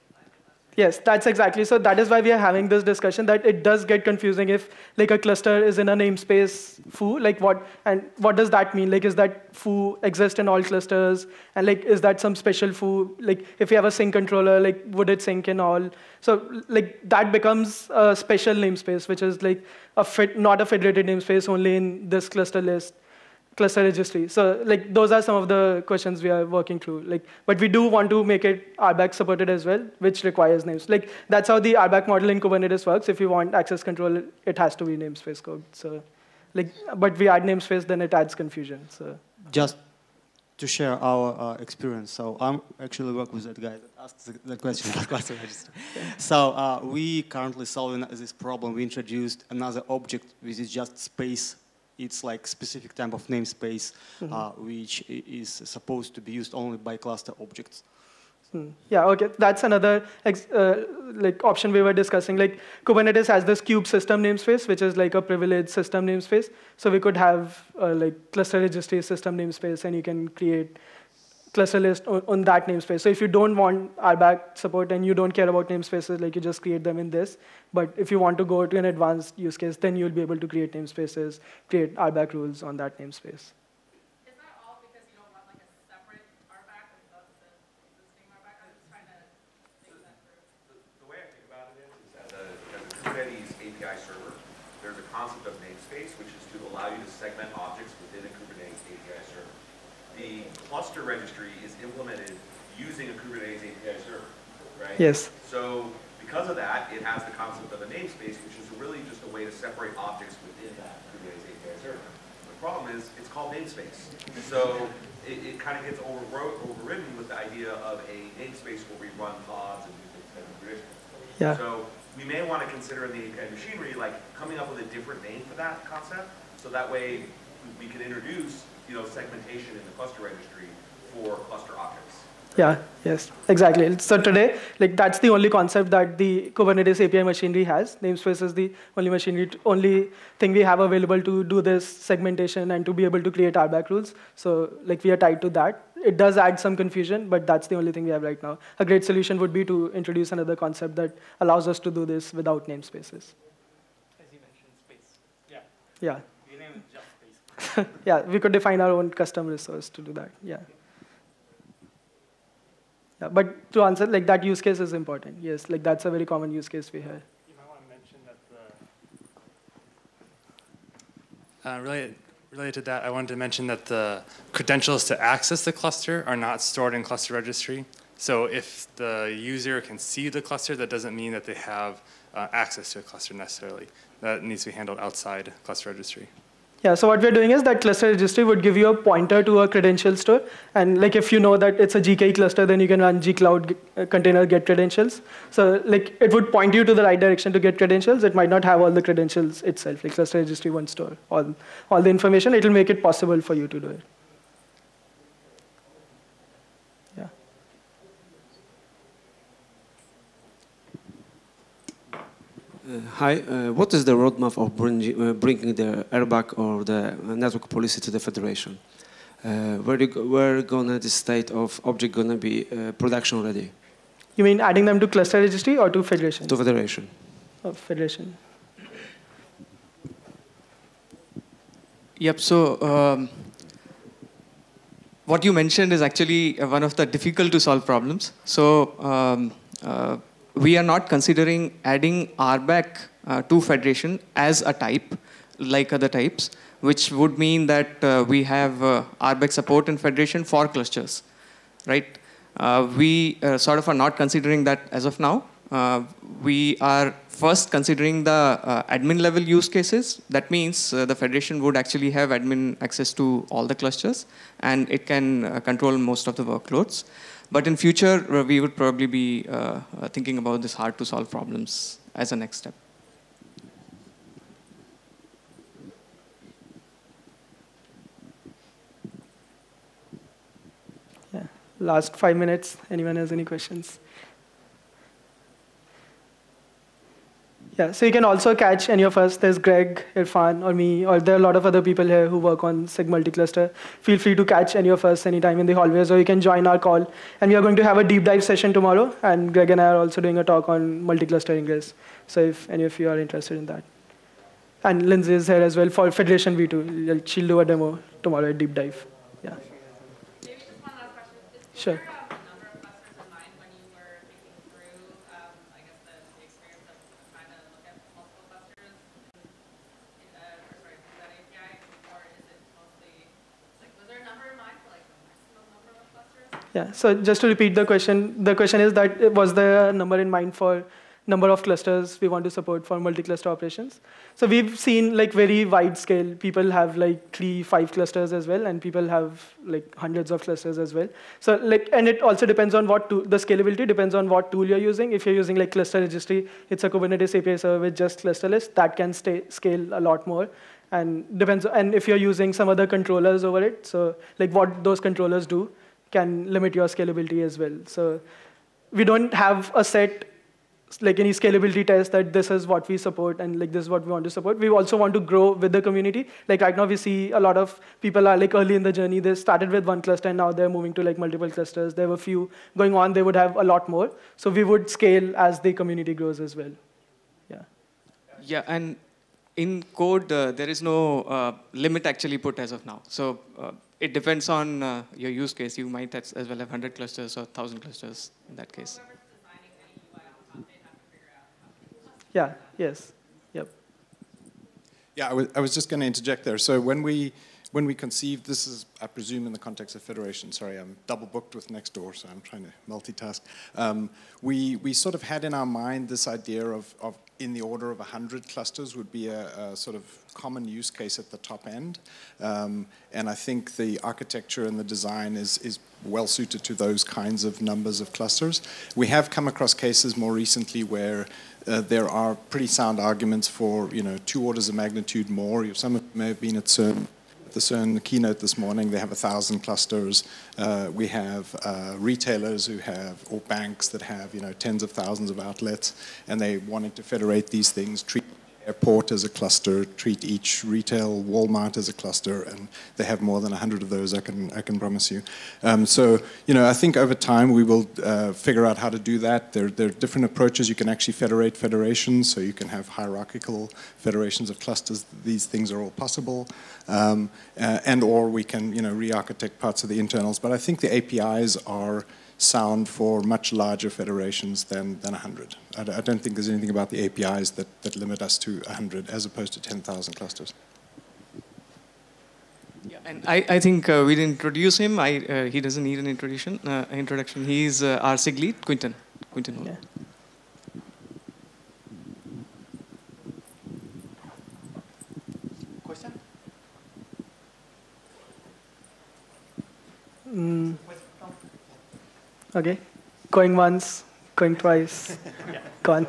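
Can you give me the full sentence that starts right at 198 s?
It might not have all the credentials itself, like cluster registry won't store all, all the information.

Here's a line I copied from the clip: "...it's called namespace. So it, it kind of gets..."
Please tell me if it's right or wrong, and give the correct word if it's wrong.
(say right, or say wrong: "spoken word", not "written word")
right.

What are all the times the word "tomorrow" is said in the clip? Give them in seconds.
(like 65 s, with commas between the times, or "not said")
298 s, 308 s.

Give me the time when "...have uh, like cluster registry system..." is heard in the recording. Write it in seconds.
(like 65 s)
67 s.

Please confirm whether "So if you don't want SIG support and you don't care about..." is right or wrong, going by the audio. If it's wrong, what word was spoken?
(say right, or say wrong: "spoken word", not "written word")
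wrong: "RBAC", not "SIG".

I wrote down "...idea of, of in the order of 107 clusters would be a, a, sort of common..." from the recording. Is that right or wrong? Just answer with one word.
wrong.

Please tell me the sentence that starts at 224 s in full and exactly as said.
You mean adding them to cluster registry or to federation?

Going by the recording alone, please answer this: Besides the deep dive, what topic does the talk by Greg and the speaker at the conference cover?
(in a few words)
multi-cluster ingress.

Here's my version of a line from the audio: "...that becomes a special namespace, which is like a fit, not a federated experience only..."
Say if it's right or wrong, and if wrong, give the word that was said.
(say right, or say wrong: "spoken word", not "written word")
wrong: "namespace", not "experience".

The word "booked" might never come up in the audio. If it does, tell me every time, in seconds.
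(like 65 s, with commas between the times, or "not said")
401 s.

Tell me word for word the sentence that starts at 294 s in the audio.
Feel free to catch any of us anytime in the hallways, or you can join our call.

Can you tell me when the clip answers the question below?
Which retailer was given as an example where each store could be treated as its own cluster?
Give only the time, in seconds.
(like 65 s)
441 s.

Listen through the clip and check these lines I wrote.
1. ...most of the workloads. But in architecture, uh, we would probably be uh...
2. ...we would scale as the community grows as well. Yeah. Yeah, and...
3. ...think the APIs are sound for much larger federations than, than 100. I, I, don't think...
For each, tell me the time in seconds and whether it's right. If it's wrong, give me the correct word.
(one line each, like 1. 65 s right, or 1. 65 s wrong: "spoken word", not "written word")
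1. 265 s wrong: "future", not "architecture"
2. 374 s right
3. 460 s right.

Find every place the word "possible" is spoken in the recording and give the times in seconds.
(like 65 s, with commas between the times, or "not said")
202 s, 455 s.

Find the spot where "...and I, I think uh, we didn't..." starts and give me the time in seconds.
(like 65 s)
473 s.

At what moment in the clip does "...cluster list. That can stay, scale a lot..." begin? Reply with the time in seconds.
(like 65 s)
348 s.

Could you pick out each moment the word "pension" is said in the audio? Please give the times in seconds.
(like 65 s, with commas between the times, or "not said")
not said.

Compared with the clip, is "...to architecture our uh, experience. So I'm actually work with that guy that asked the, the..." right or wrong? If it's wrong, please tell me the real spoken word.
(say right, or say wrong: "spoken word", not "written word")
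wrong: "share", not "architecture".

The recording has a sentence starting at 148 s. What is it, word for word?
A great solution would be to introduce another concept that allows us to do this without namespaces.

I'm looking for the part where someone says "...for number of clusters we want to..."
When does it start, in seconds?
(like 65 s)
330 s.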